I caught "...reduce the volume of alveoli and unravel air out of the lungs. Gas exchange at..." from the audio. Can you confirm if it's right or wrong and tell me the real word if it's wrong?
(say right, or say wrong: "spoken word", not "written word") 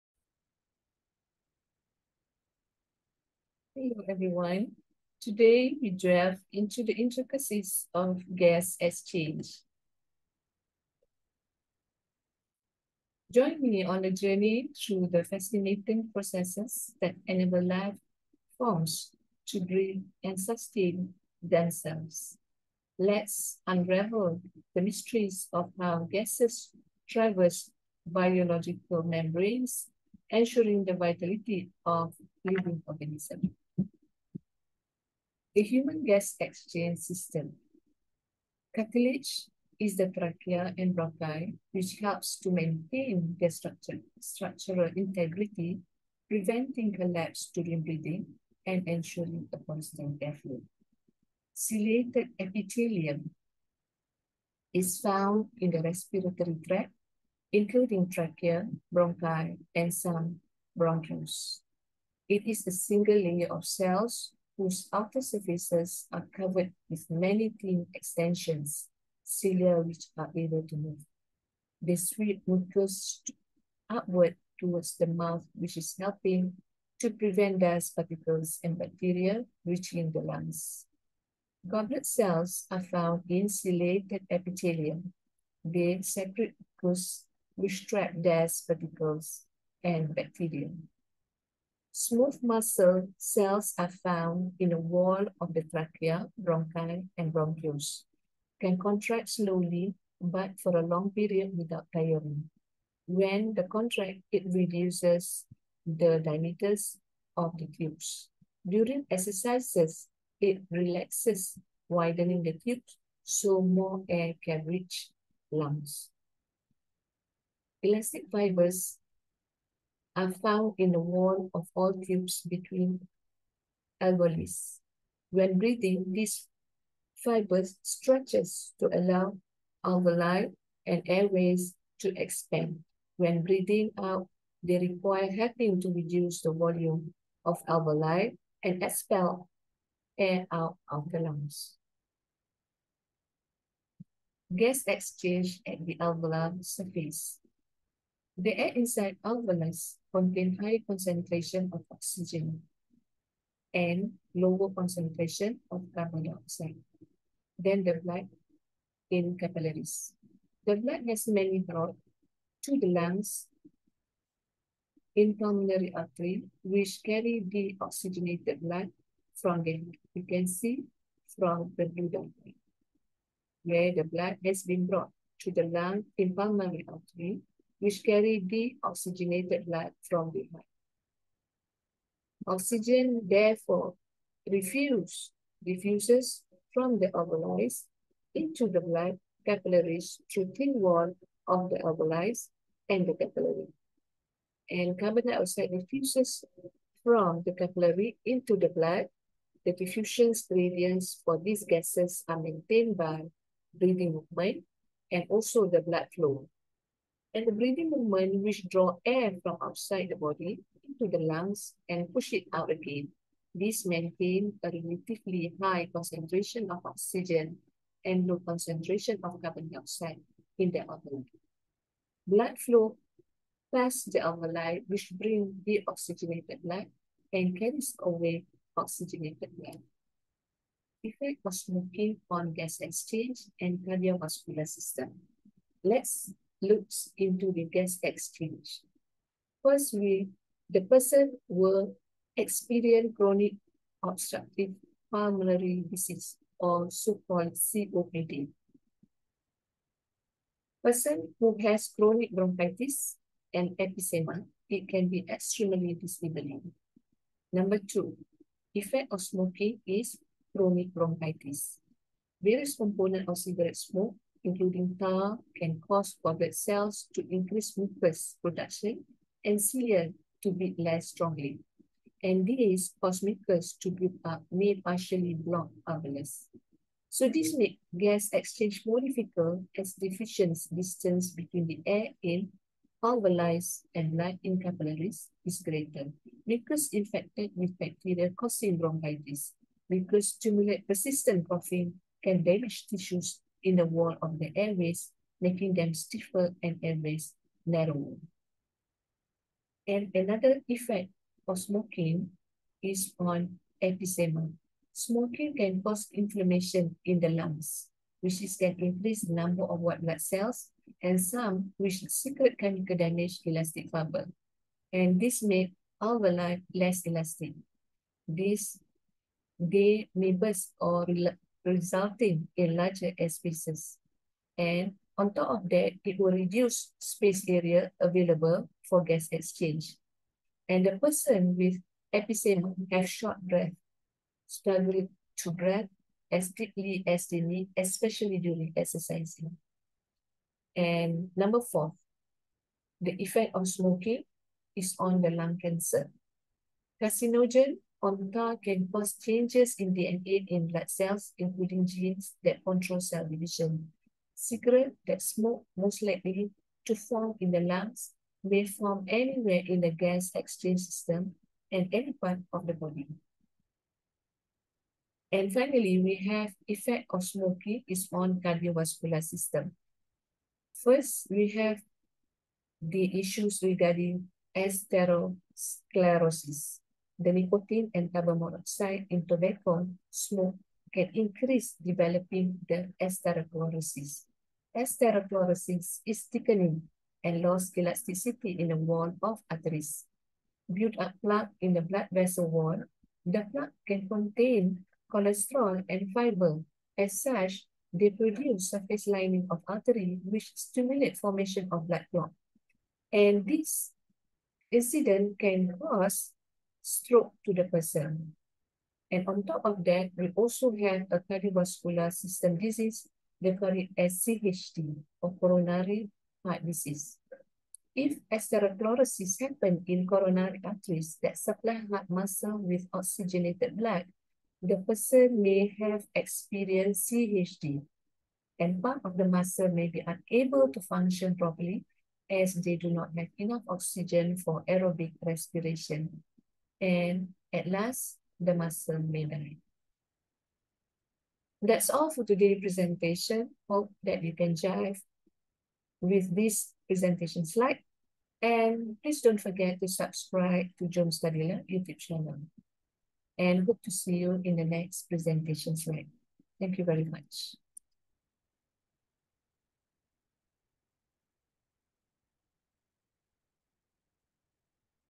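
wrong: "expel", not "unravel".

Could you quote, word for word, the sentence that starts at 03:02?
Oxygen, therefore, refuse, from the alveoli into the blood capillaries through thin wall of the alveoli and the capillary.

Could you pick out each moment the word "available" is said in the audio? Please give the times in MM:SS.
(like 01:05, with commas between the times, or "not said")
05:28.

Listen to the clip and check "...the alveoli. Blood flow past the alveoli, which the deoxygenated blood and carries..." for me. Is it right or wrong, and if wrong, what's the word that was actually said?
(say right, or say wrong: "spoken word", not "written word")
right.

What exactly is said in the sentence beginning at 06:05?
And finally, we have effect of smoking is on cardiovascular system.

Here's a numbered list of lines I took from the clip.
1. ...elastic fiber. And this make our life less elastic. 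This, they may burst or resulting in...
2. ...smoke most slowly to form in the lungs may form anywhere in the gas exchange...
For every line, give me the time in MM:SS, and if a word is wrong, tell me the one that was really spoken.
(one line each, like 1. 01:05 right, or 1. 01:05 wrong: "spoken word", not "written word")
1. 05:13 right
2. 05:55 wrong: "likely", not "slowly".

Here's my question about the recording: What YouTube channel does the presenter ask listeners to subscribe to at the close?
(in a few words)
Joom Studyla.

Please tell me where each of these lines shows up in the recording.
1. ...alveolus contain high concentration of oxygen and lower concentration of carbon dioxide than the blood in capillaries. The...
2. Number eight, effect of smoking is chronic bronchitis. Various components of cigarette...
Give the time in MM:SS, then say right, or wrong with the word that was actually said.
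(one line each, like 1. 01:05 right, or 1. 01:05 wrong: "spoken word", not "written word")
1. 02:29 right
2. 04:17 wrong: "two", not "eight".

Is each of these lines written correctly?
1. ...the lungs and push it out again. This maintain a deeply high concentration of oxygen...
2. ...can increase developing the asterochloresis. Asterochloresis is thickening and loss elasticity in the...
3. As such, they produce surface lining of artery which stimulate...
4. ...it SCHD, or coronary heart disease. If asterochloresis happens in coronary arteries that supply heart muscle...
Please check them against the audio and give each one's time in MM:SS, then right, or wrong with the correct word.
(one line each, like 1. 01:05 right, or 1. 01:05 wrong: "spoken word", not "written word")
1. 03:31 wrong: "relatively", not "deeply"
2. 06:20 right
3. 06:36 right
4. 06:53 wrong: "atherosclerosis", not "asterochloresis".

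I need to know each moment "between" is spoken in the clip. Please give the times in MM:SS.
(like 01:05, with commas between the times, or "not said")
02:02, 04:41.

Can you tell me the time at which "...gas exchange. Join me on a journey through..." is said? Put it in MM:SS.
00:08.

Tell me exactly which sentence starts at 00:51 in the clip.
Ciliated epithelium is found in the respiratory tract, including trachea, bronchi, and some bronchioles.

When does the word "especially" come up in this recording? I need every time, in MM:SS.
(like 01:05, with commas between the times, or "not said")
05:37.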